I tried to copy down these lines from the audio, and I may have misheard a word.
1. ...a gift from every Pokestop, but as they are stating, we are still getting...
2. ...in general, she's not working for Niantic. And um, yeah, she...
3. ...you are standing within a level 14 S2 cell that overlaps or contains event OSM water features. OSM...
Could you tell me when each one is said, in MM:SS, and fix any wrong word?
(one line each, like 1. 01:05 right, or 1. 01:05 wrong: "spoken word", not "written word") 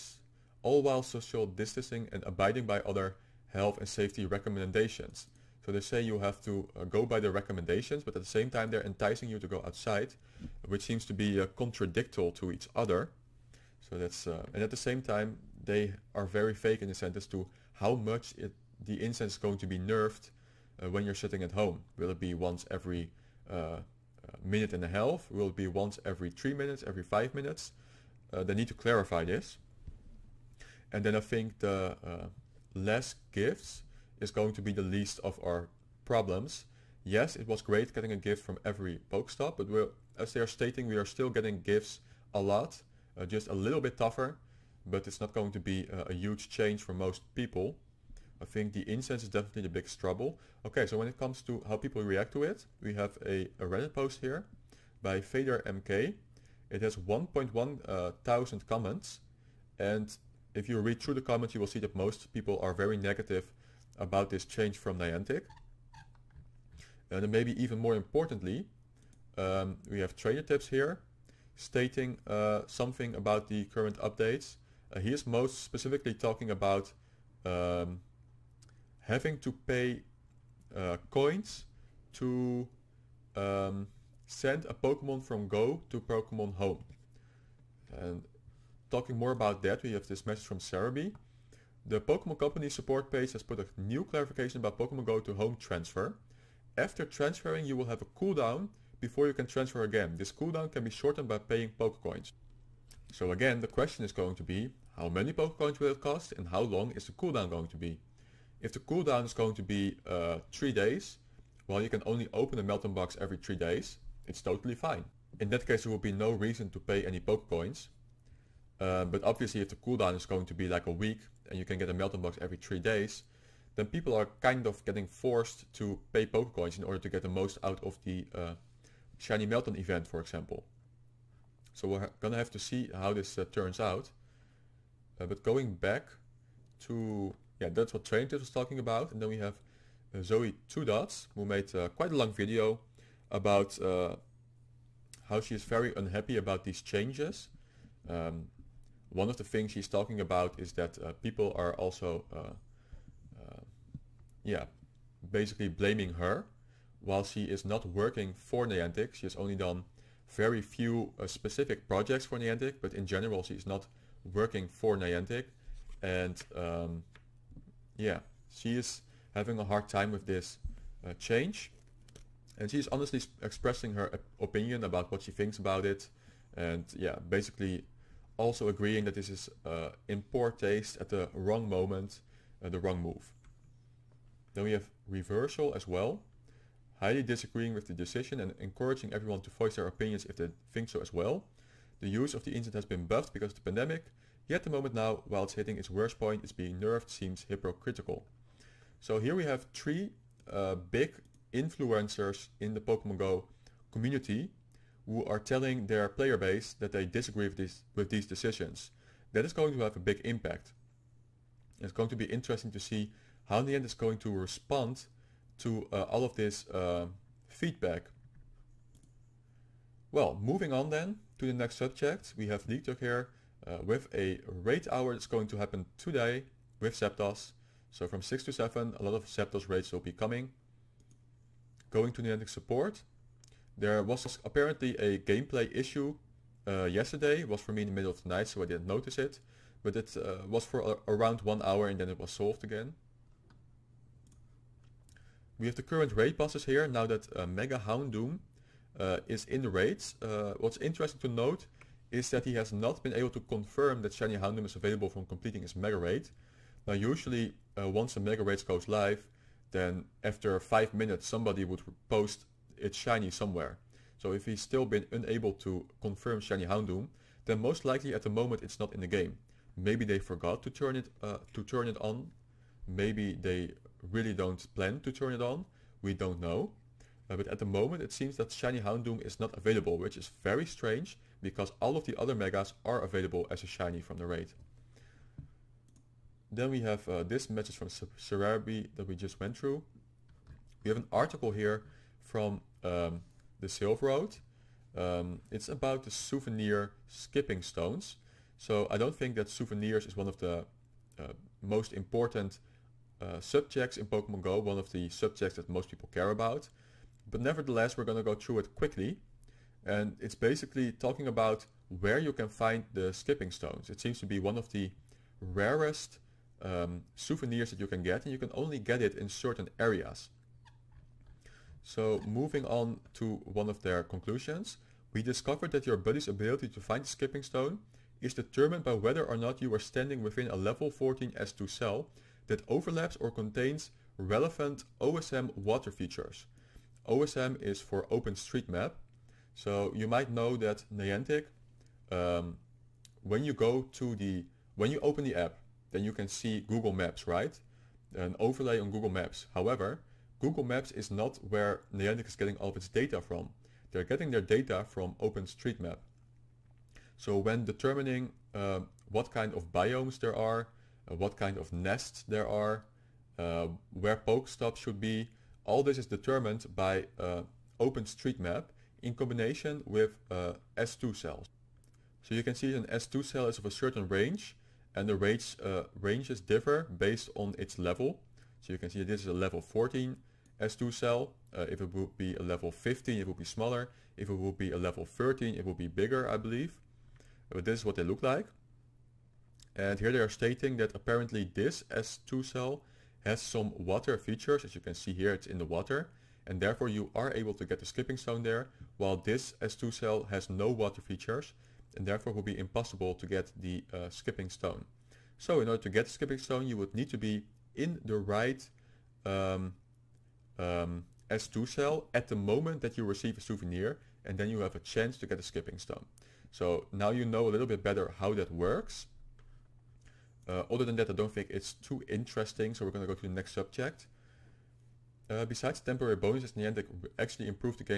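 1. 00:38 right
2. 02:42 right
3. 05:29 wrong: "relevant", not "event".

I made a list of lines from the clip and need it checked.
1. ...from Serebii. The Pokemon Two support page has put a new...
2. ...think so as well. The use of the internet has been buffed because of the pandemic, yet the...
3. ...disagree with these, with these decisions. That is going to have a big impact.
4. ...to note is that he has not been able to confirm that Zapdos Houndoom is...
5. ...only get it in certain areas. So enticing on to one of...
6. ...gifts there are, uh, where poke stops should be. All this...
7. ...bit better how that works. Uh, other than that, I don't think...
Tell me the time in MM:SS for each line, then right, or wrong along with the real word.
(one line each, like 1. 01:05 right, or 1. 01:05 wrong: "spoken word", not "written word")
1. 01:30 wrong: "Company", not "Two"
2. 03:10 right
3. 03:27 right
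4. 04:11 wrong: "Shiny", not "Zapdos"
5. 05:18 wrong: "moving", not "enticing"
6. 06:01 wrong: "nests", not "gifts"
7. 06:57 right.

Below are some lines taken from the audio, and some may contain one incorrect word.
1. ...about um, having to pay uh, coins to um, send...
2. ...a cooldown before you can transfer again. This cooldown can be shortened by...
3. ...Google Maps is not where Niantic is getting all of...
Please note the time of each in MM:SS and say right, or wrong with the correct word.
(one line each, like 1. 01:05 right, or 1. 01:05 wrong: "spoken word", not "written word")
1. 01:16 right
2. 01:38 right
3. 05:50 right.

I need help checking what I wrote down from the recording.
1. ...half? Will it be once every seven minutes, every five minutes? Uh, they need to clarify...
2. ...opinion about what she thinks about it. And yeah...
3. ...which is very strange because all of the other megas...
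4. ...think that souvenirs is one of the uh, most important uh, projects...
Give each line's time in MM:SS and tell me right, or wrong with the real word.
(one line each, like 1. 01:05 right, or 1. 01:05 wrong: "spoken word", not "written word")
1. 00:24 wrong: "three", not "seven"
2. 02:54 right
3. 04:39 right
4. 04:59 wrong: "subjects", not "projects".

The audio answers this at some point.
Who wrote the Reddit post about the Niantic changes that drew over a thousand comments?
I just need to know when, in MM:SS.
00:55.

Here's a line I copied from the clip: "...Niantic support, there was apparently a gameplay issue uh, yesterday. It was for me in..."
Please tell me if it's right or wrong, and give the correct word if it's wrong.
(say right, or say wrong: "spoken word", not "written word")
right.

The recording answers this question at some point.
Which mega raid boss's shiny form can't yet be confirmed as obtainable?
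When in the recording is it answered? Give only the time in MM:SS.
04:07.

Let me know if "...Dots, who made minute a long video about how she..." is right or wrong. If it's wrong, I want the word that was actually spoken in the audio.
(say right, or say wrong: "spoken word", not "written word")
wrong: "quite", not "minute".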